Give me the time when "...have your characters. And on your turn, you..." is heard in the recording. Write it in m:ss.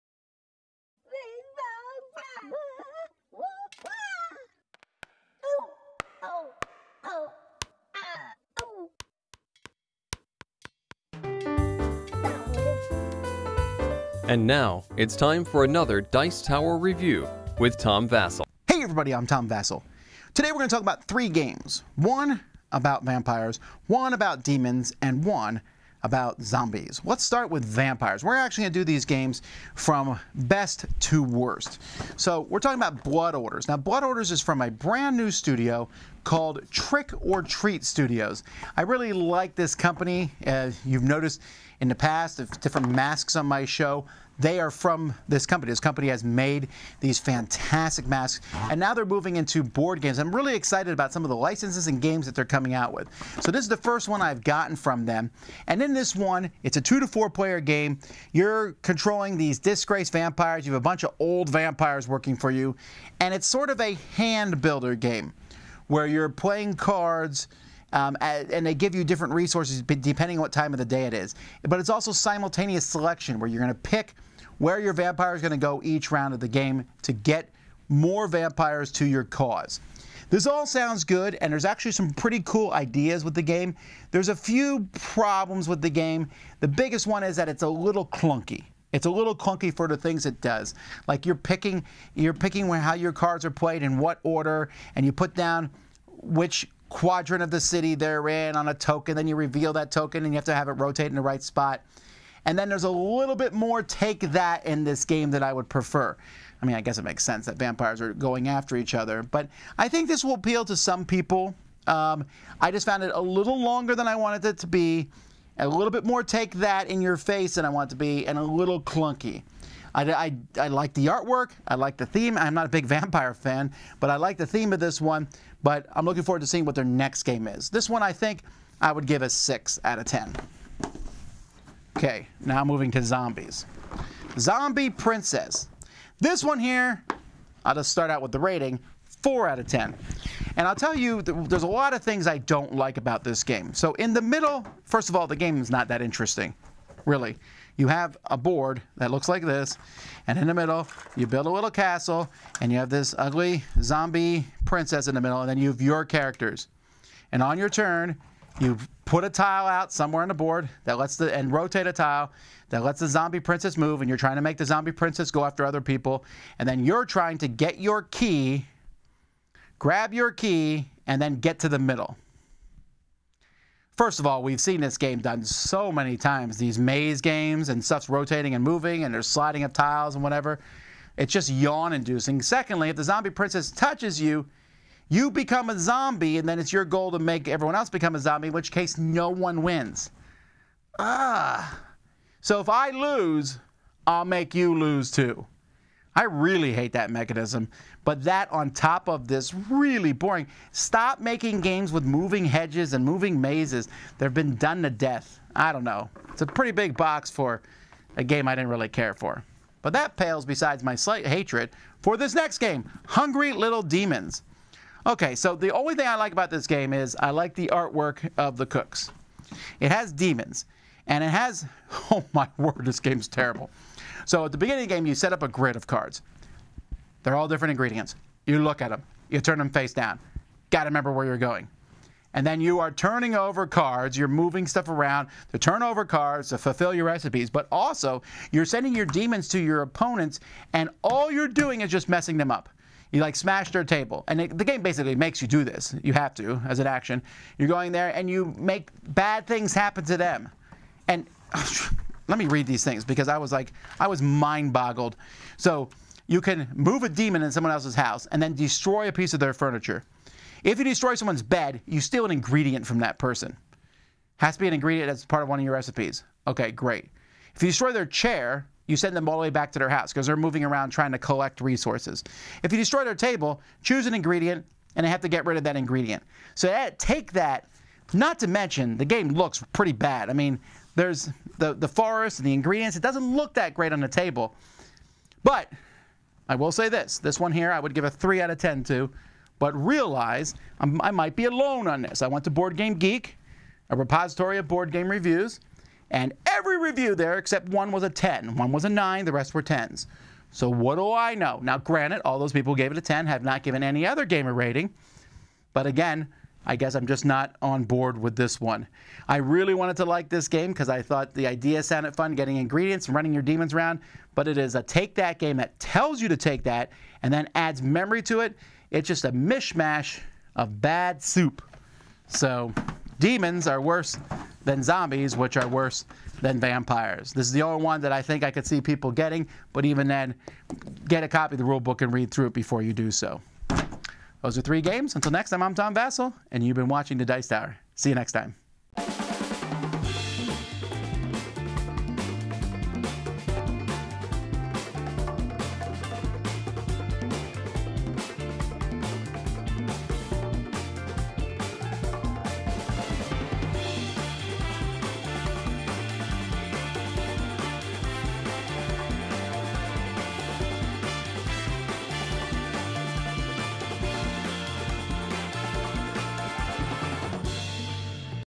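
2:35.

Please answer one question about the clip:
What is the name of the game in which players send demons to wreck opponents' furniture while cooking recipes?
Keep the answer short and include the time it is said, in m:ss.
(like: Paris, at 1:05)
Hungry Little Demons, at 3:33.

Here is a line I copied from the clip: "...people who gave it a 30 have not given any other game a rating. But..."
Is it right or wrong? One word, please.
wrong.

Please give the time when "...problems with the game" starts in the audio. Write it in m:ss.
1:24.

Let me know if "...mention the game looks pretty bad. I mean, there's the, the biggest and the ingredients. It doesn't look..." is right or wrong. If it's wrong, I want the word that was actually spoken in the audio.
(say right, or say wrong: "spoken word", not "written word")
wrong: "forest", not "biggest".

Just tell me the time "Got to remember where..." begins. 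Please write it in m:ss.
3:50.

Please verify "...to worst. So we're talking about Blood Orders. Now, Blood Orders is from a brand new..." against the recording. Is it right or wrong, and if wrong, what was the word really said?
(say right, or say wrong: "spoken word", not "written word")
right.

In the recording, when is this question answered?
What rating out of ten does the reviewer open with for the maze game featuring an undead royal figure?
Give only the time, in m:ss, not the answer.
2:19.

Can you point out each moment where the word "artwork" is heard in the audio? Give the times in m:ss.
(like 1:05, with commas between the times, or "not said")
2:01, 3:37.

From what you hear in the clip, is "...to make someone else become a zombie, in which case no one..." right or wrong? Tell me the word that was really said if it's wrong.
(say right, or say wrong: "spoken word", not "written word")
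wrong: "everyone", not "someone".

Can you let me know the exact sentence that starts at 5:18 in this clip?
It's just a mishmash of bad soup.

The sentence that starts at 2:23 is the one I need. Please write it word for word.
So in the middle, first of all, the game is not that interesting, really.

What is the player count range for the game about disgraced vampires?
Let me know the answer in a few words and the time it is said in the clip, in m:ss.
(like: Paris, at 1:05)
2 to 4, at 0:56.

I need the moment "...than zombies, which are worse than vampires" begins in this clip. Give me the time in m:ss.
5:24.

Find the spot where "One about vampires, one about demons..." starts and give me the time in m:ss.
0:21.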